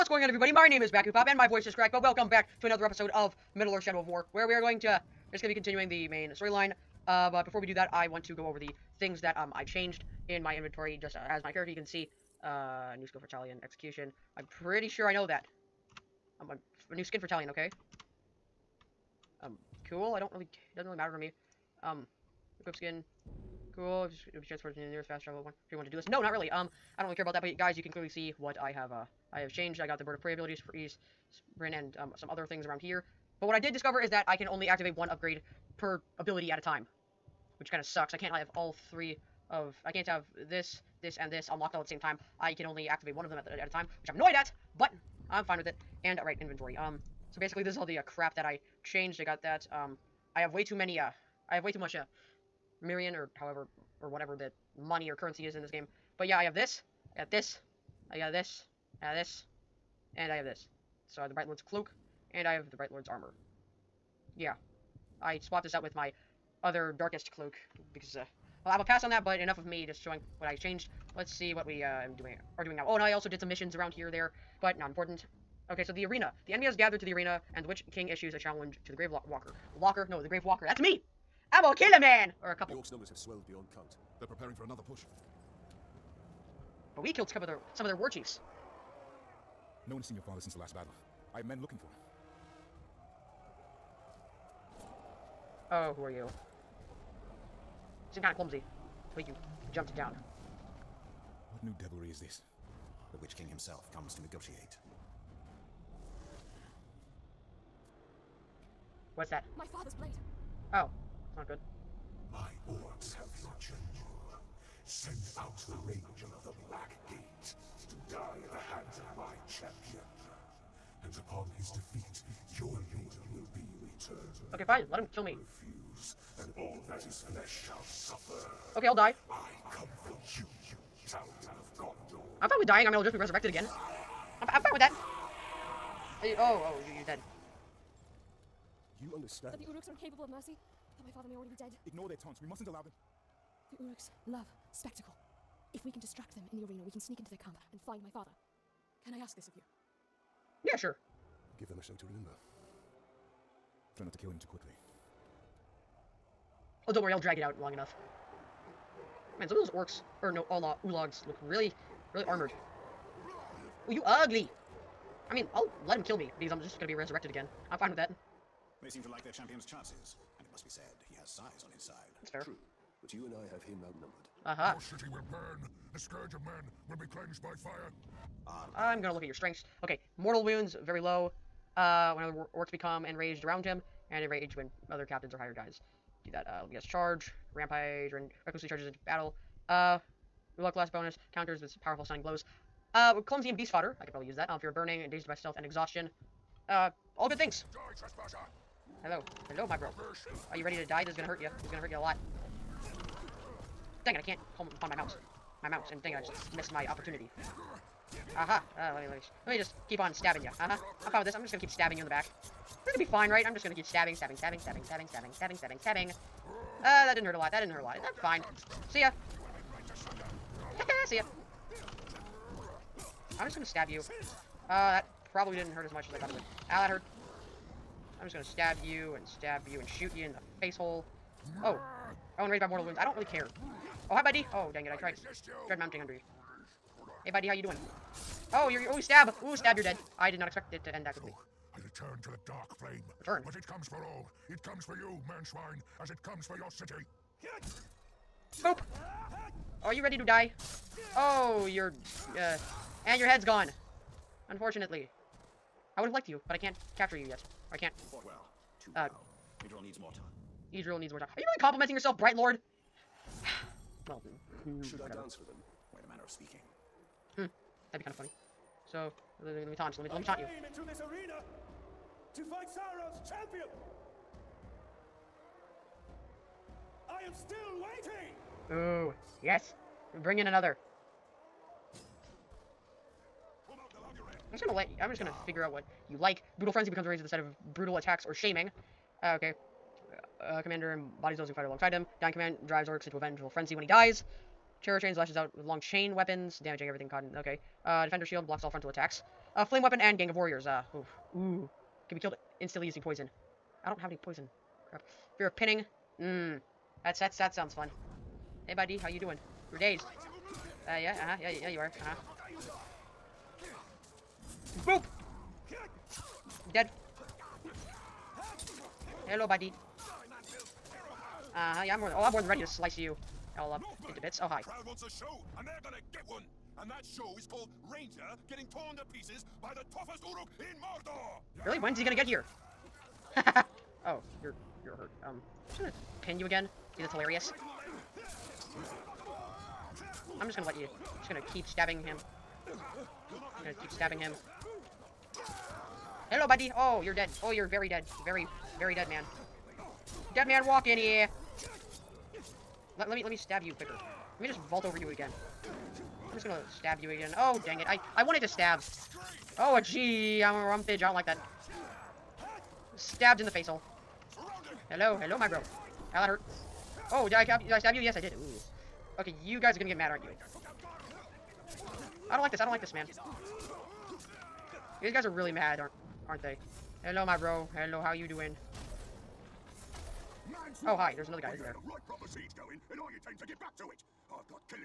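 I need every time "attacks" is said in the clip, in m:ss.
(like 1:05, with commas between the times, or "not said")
4:47, 4:58.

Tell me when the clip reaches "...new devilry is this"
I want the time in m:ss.
1:41.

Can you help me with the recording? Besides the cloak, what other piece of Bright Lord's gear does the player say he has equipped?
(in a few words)
Bright Lord's armor.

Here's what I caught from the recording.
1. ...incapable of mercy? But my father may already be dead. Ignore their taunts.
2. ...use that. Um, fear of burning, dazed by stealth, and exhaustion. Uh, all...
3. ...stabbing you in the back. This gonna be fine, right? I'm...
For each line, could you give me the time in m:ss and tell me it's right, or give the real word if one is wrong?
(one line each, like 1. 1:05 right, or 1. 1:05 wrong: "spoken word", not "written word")
1. 2:19 right
2. 3:14 right
3. 3:31 right.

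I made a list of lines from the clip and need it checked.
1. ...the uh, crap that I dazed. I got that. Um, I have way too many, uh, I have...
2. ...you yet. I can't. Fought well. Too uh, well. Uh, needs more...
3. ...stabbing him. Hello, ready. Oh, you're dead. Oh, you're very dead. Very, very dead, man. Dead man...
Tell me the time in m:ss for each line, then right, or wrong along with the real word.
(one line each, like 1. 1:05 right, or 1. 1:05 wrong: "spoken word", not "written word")
1. 0:47 wrong: "changed", not "dazed"
2. 4:17 right
3. 5:43 wrong: "buddy", not "ready".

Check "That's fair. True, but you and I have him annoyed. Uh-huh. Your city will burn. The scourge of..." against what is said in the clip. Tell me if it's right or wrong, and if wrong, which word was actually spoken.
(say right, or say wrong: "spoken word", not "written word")
wrong: "outnumbered", not "annoyed".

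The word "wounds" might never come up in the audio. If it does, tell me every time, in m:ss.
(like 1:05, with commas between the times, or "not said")
3:00, 3:52.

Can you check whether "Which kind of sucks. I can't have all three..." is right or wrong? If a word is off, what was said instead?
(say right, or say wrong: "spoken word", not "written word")
right.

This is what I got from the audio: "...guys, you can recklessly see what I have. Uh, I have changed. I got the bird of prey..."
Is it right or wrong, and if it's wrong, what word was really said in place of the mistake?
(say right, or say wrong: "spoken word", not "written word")
wrong: "clearly", not "recklessly".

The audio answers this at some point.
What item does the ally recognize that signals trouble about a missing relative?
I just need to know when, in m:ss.
1:49.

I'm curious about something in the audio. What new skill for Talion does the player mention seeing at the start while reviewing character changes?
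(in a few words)
Execution.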